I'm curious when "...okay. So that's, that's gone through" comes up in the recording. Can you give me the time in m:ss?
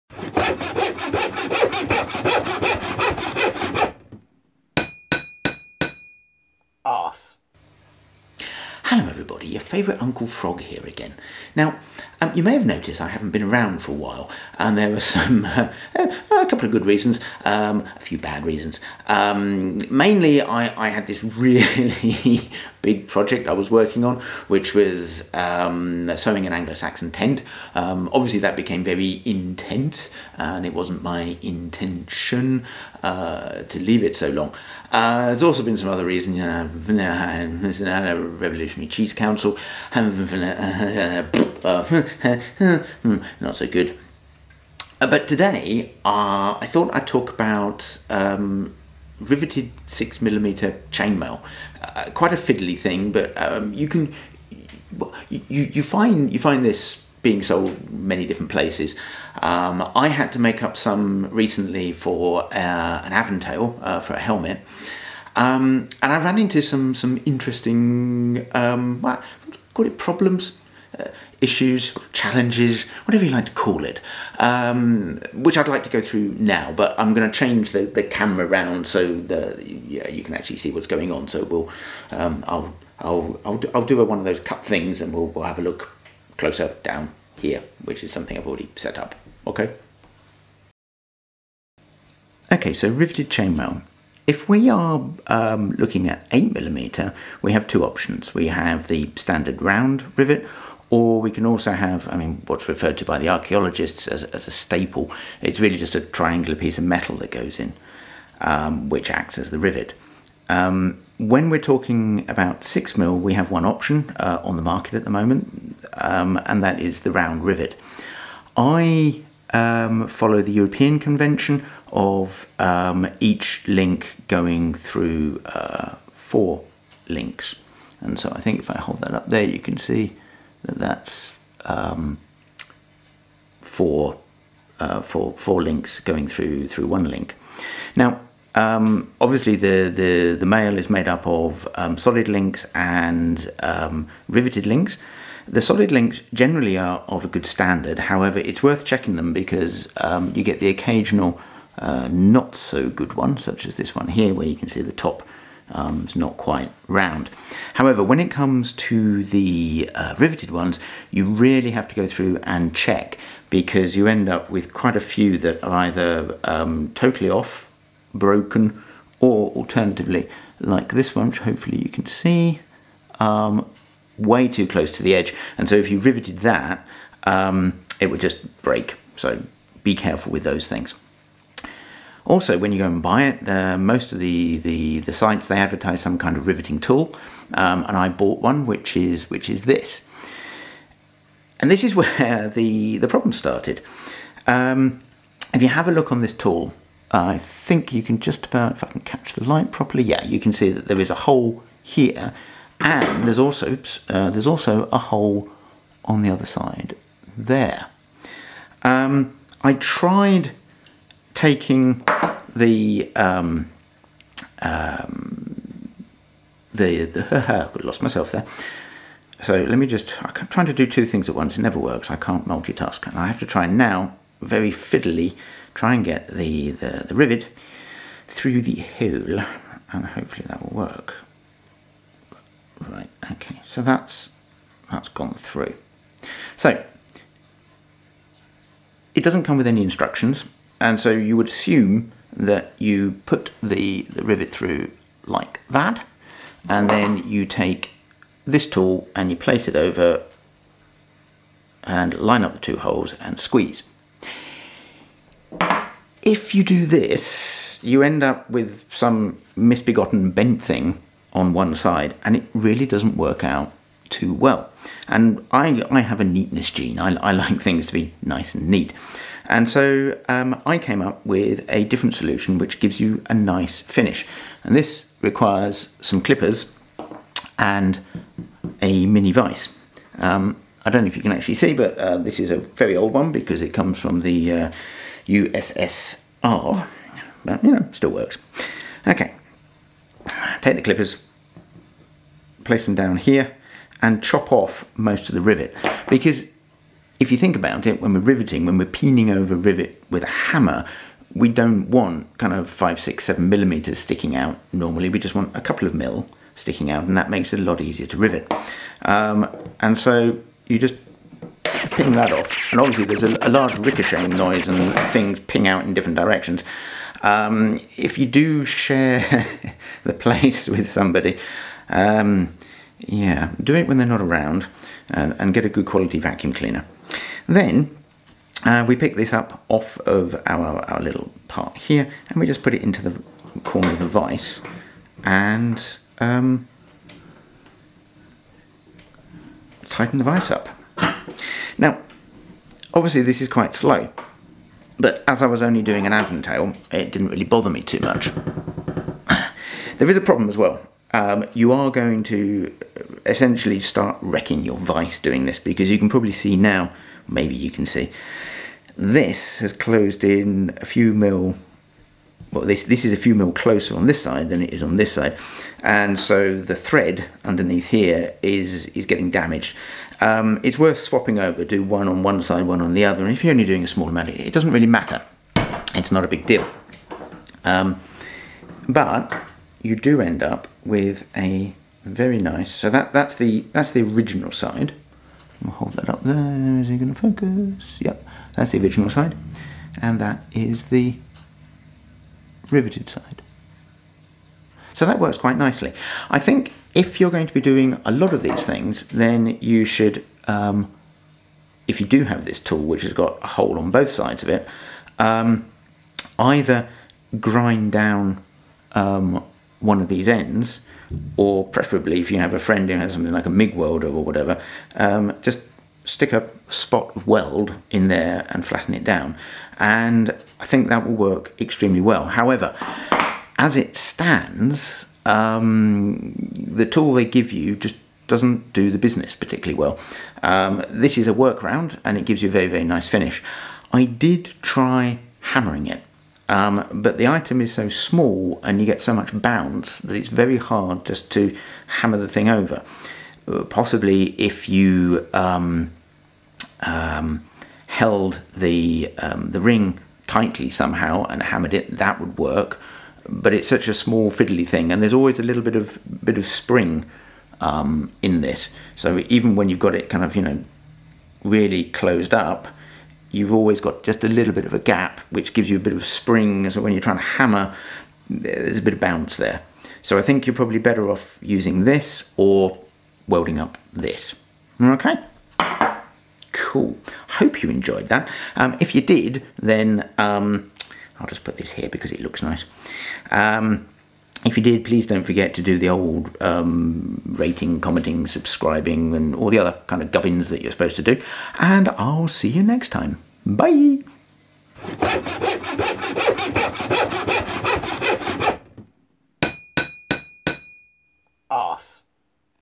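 3:53.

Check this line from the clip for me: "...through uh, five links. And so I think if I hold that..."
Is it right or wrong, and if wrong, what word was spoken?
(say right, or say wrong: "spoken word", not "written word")
wrong: "four", not "five".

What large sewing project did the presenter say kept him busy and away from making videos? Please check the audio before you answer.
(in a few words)
Anglo-Saxon tent.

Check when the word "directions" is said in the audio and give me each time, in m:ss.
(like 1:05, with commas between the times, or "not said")
5:16.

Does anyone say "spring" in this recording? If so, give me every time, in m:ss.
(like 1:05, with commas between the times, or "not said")
7:36, 7:46.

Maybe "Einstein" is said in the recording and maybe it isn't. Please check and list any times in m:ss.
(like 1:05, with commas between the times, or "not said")
not said.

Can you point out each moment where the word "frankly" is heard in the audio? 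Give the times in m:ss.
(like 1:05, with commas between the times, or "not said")
not said.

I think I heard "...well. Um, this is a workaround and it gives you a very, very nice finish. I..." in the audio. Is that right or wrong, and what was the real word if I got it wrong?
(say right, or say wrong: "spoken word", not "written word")
right.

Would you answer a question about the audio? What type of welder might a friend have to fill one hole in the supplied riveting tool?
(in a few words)
MIG welder.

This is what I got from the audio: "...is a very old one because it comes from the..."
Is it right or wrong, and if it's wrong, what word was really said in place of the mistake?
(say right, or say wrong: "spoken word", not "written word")
right.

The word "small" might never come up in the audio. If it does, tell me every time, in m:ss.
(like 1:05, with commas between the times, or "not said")
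6:13, 7:17, 7:33.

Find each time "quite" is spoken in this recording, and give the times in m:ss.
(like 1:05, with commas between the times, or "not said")
0:52, 2:36, 2:44, 5:43, 6:35.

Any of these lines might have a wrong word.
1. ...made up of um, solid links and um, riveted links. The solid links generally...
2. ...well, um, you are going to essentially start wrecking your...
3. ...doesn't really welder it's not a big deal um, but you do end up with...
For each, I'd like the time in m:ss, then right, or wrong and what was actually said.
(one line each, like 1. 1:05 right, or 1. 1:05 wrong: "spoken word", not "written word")
1. 2:20 right
2. 5:50 right
3. 6:14 wrong: "matter", not "welder".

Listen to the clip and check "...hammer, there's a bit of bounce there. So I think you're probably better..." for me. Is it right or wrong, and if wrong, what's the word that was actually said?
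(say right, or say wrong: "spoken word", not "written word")
right.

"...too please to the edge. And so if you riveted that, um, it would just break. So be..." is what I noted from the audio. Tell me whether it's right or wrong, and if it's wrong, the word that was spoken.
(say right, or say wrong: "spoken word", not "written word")
wrong: "close", not "please".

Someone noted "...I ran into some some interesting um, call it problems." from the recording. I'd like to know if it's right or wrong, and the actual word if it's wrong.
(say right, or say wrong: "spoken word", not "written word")
right.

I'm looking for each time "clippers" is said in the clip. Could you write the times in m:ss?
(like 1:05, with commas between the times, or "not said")
4:36, 4:50.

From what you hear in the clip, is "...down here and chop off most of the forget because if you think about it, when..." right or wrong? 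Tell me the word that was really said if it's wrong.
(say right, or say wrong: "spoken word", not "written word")
wrong: "rivet", not "forget".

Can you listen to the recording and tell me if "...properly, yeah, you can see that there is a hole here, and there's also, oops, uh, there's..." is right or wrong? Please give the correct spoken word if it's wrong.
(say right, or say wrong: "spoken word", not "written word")
right.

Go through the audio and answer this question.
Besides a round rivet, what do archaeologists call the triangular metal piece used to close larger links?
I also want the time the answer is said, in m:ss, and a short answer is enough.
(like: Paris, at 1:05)
staple, at 1:44.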